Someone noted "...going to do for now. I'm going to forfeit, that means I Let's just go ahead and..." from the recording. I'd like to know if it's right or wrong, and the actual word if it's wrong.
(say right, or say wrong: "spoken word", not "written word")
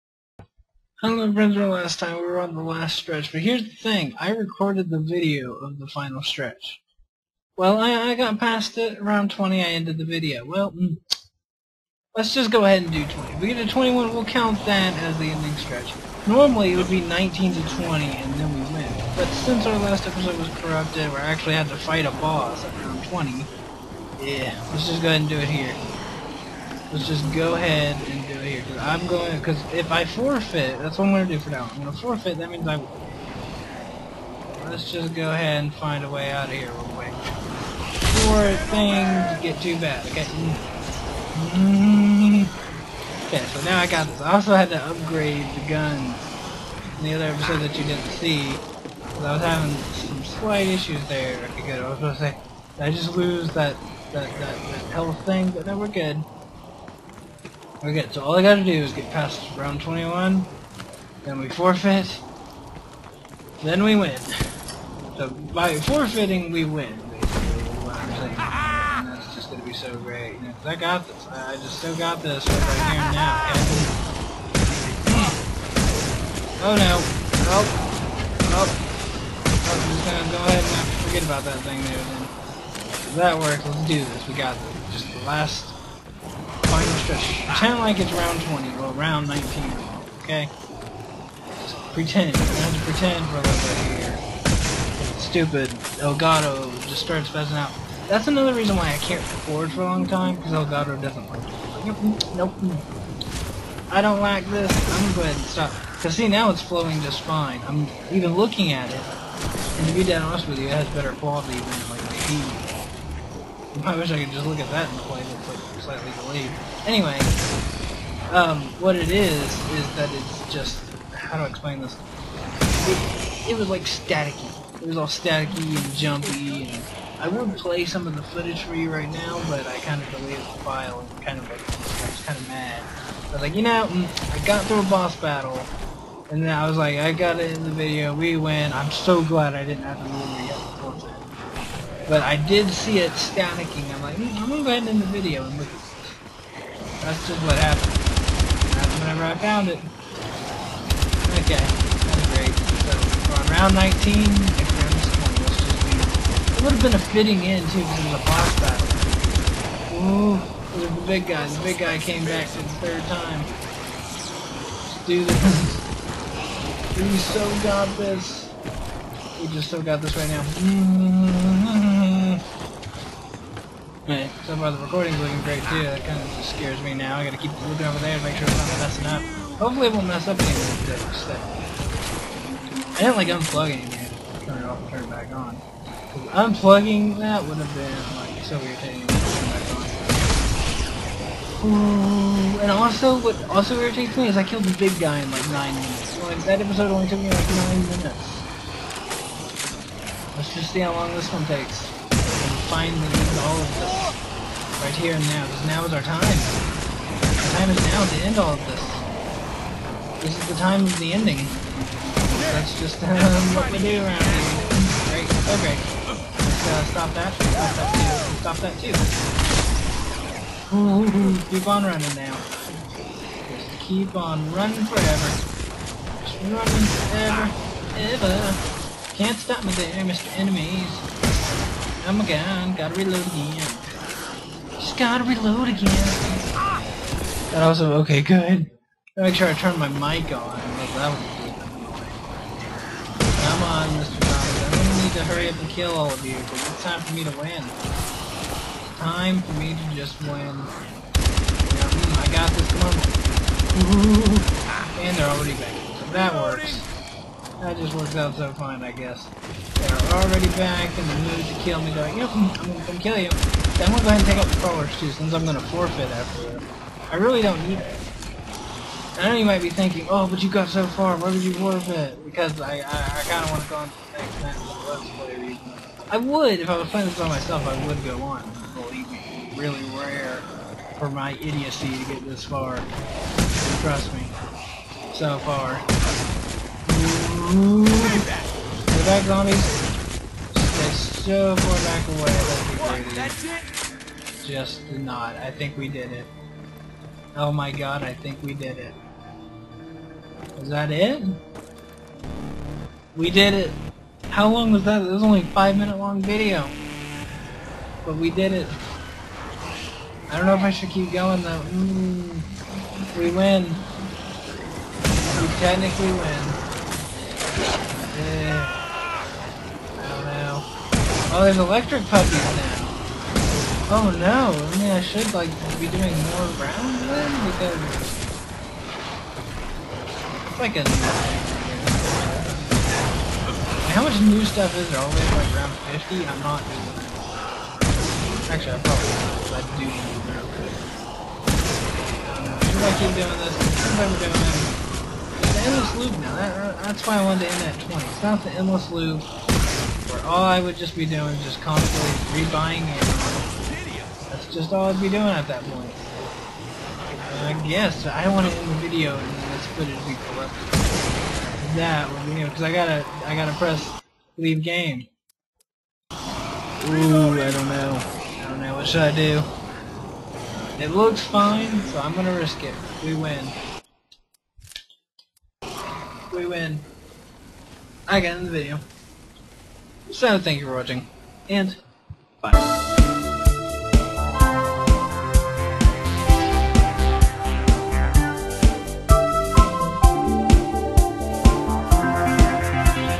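right.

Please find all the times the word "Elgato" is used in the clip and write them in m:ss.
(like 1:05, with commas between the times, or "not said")
1:36, 1:40.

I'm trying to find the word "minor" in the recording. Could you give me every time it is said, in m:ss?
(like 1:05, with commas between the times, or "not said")
not said.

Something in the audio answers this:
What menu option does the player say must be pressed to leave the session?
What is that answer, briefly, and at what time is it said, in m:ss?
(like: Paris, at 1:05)
leave game, at 6:04.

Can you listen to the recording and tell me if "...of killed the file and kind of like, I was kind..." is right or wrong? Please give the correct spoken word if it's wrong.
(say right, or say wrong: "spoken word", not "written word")
wrong: "deleted", not "killed".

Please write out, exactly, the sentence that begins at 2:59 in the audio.
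Hopefully it won't mess up any of the I didn't like unplugging it.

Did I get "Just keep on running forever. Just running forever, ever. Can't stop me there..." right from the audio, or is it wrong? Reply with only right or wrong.
right.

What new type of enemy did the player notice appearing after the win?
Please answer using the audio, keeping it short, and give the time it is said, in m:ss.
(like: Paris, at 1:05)
electric puppies, at 5:21.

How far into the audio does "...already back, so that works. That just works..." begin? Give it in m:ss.
4:15.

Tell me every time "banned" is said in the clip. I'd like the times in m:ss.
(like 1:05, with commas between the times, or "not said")
not said.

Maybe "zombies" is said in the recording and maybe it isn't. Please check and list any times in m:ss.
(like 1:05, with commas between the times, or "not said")
4:49.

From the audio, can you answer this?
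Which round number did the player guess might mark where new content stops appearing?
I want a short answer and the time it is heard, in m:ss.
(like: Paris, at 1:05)
50, at 5:35.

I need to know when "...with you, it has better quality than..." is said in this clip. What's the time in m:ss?
1:50.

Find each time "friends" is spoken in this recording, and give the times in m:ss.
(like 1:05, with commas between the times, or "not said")
0:01.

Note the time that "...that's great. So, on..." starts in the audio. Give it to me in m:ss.
2:31.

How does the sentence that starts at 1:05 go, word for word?
So by forfeiting, we win, basically, that's just gonna be so great.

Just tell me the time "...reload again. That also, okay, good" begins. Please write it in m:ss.
3:55.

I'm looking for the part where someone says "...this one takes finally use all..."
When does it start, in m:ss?
3:21.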